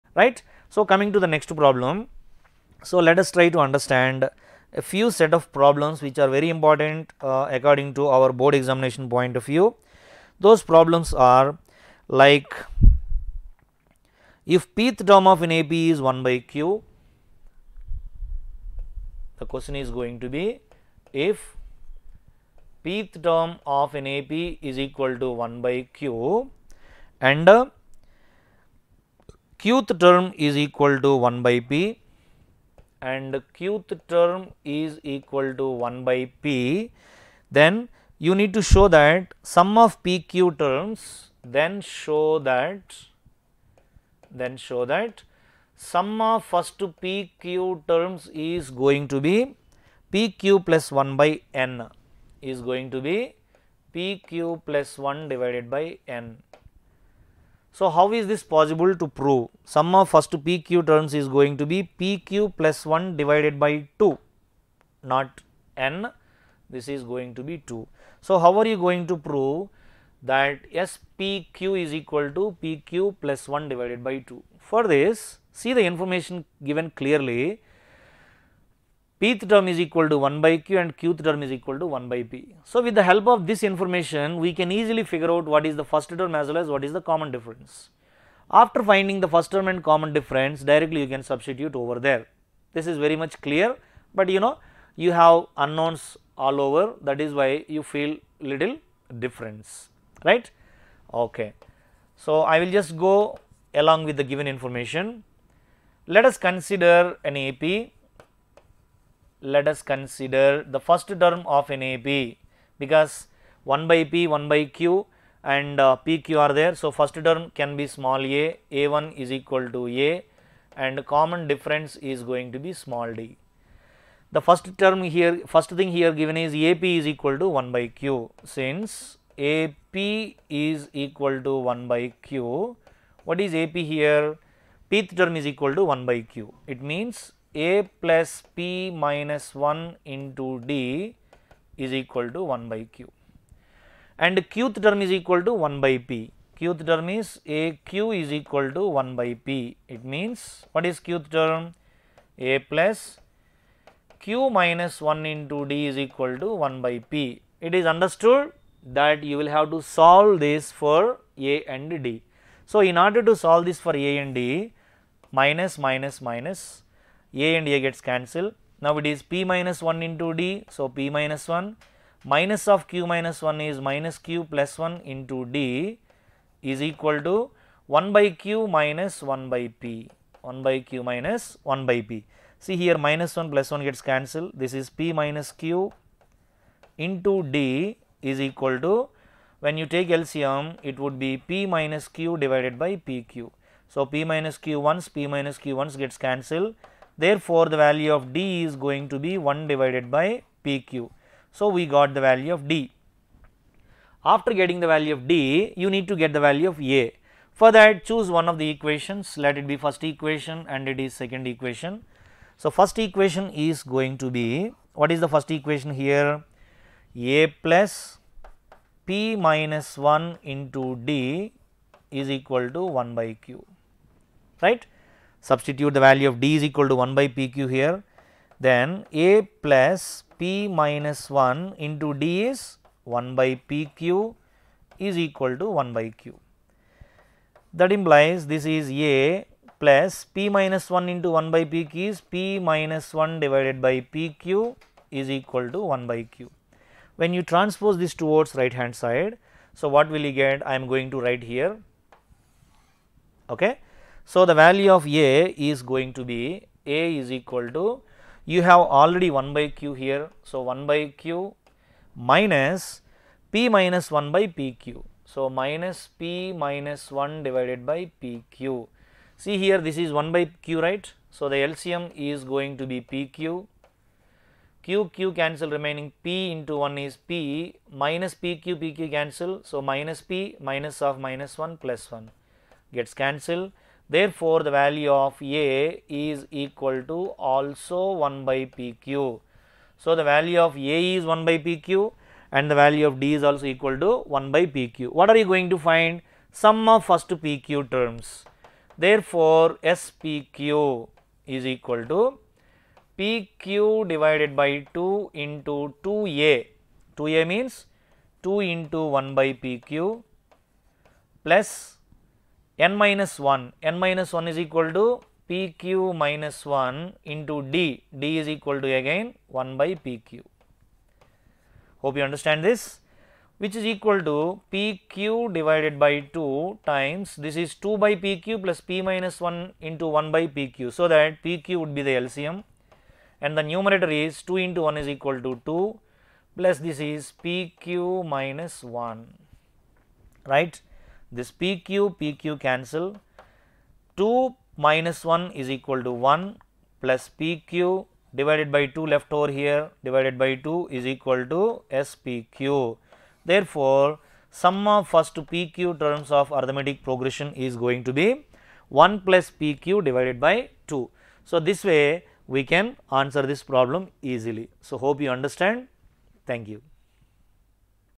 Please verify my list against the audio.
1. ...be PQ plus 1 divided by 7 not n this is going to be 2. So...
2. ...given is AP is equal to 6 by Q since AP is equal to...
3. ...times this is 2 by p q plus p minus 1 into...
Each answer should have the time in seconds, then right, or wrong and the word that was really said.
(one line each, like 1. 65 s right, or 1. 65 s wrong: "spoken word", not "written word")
1. 61 s wrong: "2", not "7"
2. 126 s wrong: "1", not "6"
3. 326 s right.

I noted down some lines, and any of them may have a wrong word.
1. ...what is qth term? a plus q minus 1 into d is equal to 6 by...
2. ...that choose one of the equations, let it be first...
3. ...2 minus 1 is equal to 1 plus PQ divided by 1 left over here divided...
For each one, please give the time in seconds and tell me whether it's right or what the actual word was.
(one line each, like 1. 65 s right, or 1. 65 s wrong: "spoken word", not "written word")
1. 150 s wrong: "1", not "6"
2. 207 s right
3. 344 s wrong: "2", not "1".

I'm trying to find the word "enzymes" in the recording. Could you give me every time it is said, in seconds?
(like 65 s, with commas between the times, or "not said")
not said.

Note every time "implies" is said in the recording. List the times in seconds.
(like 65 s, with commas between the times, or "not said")
237 s.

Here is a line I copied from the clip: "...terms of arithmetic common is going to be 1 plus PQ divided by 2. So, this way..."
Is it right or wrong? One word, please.
wrong.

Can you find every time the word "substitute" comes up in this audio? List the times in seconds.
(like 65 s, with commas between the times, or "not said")
91 s, 225 s.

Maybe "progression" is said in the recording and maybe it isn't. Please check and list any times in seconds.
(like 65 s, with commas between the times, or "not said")
357 s.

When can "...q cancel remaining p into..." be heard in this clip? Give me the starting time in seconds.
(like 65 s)
275 s.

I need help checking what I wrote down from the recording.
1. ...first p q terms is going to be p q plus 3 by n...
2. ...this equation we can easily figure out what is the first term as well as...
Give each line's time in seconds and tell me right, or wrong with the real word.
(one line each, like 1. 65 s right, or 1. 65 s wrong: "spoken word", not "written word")
1. 46 s wrong: "1", not "3"
2. 83 s wrong: "information", not "equation".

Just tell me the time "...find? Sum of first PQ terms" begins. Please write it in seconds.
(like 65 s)
295 s.